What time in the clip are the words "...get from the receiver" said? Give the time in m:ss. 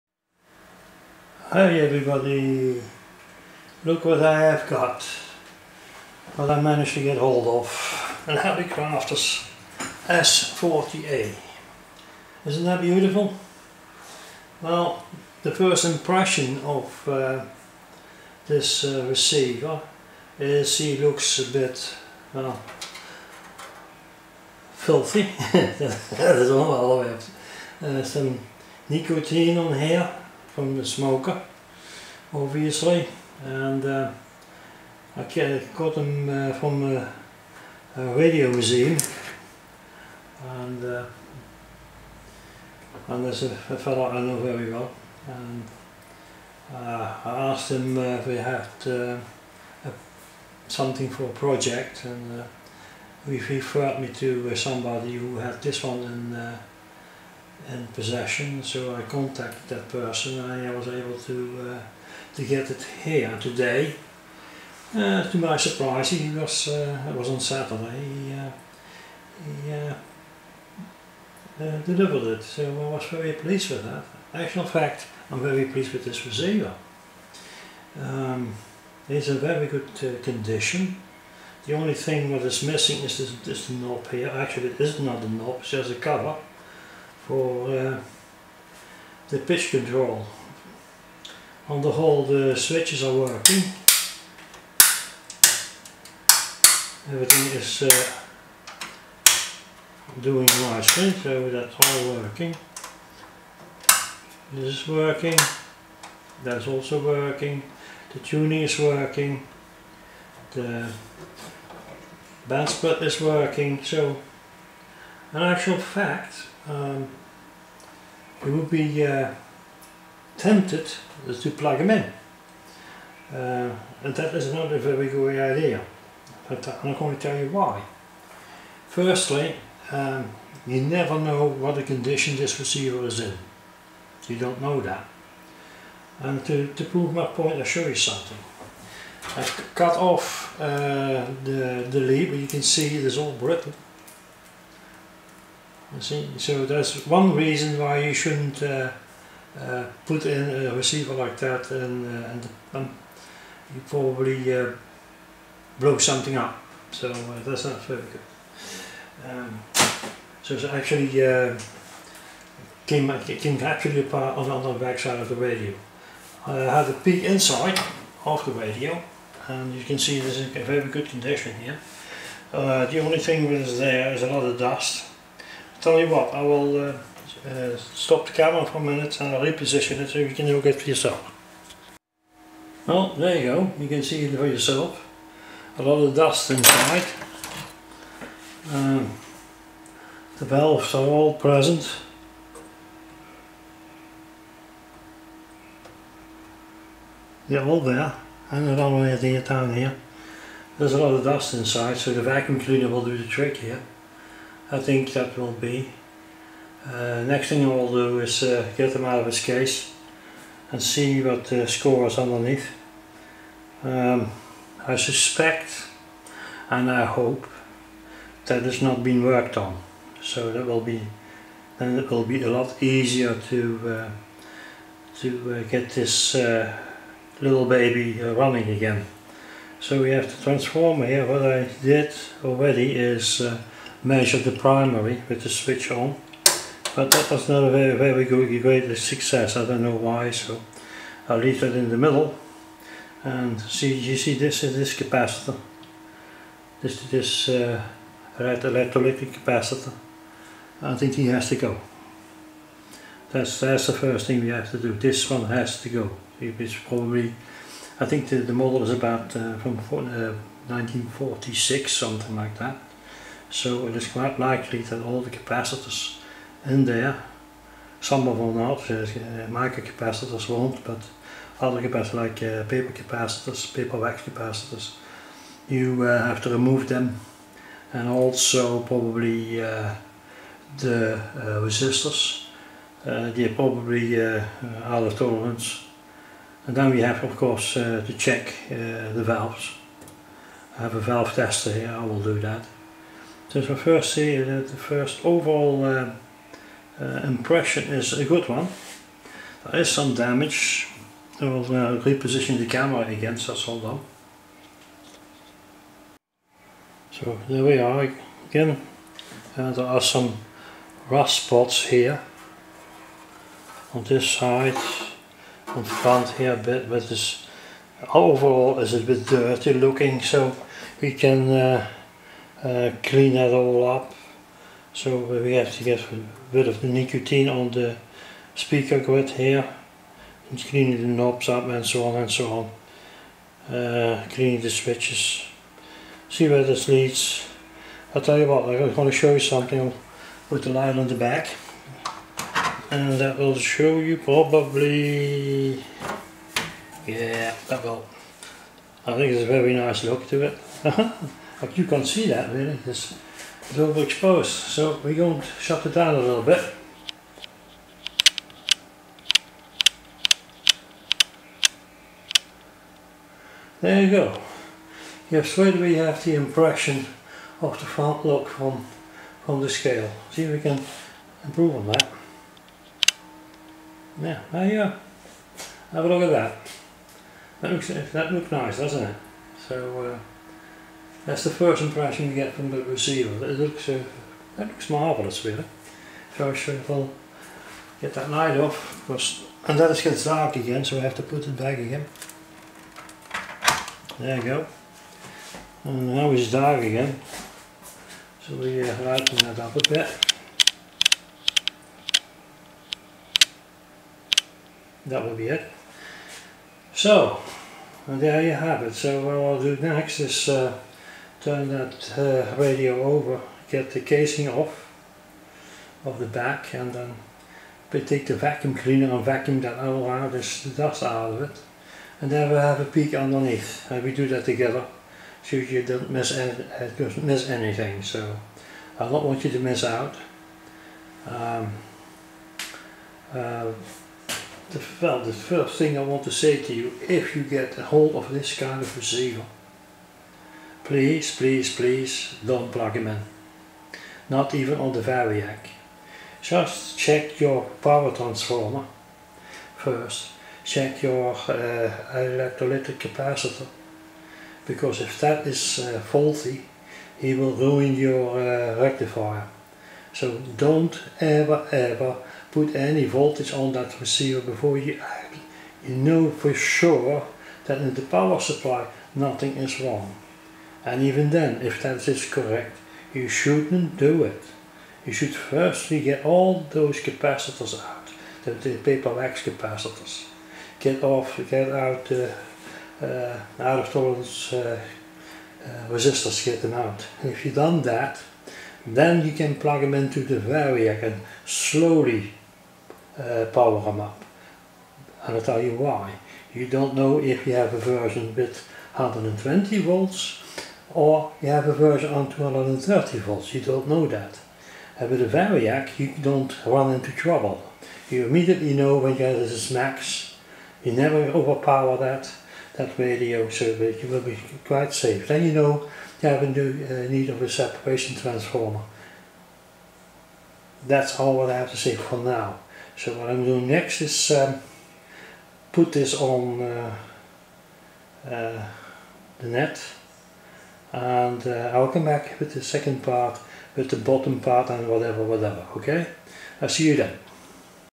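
6:22.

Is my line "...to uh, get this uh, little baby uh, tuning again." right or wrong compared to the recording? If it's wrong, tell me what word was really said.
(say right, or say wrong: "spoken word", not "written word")
wrong: "running", not "tuning".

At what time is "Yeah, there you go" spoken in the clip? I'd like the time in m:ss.
6:14.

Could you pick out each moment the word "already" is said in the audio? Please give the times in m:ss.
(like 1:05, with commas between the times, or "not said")
3:52.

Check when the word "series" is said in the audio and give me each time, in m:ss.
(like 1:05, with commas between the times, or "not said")
not said.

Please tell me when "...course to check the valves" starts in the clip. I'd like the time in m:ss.
4:47.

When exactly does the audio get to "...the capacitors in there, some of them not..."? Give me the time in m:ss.
4:25.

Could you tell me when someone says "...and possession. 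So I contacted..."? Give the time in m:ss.
0:57.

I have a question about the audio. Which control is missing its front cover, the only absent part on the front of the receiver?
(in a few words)
the pitch control.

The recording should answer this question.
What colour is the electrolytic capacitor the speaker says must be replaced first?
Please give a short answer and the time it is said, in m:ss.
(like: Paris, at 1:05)
red, at 4:08.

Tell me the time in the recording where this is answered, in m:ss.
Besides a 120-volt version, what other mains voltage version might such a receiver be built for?
8:22.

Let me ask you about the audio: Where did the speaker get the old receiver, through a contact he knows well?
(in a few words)
a radio museum.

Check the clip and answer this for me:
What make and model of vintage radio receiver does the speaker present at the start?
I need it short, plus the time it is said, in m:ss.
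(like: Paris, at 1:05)
Hallicrafters S40A, at 0:08.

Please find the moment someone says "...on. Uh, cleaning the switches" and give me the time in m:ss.
5:33.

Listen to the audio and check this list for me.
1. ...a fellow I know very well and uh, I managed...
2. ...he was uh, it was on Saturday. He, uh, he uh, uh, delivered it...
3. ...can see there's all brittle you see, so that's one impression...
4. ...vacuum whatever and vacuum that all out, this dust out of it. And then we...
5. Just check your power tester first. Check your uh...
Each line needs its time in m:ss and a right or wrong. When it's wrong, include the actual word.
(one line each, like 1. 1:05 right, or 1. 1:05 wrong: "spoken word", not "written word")
1. 0:43 wrong: "asked", not "managed"
2. 1:06 right
3. 2:22 wrong: "reason", not "impression"
4. 6:58 wrong: "cleaner", not "whatever"
5. 7:26 wrong: "transformer", not "tester".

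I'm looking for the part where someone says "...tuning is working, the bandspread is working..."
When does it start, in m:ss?
1:48.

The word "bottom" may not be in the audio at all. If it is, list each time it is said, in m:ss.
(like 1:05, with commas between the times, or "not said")
8:53.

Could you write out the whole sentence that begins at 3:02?
Well, there you go, you can see it for yourself.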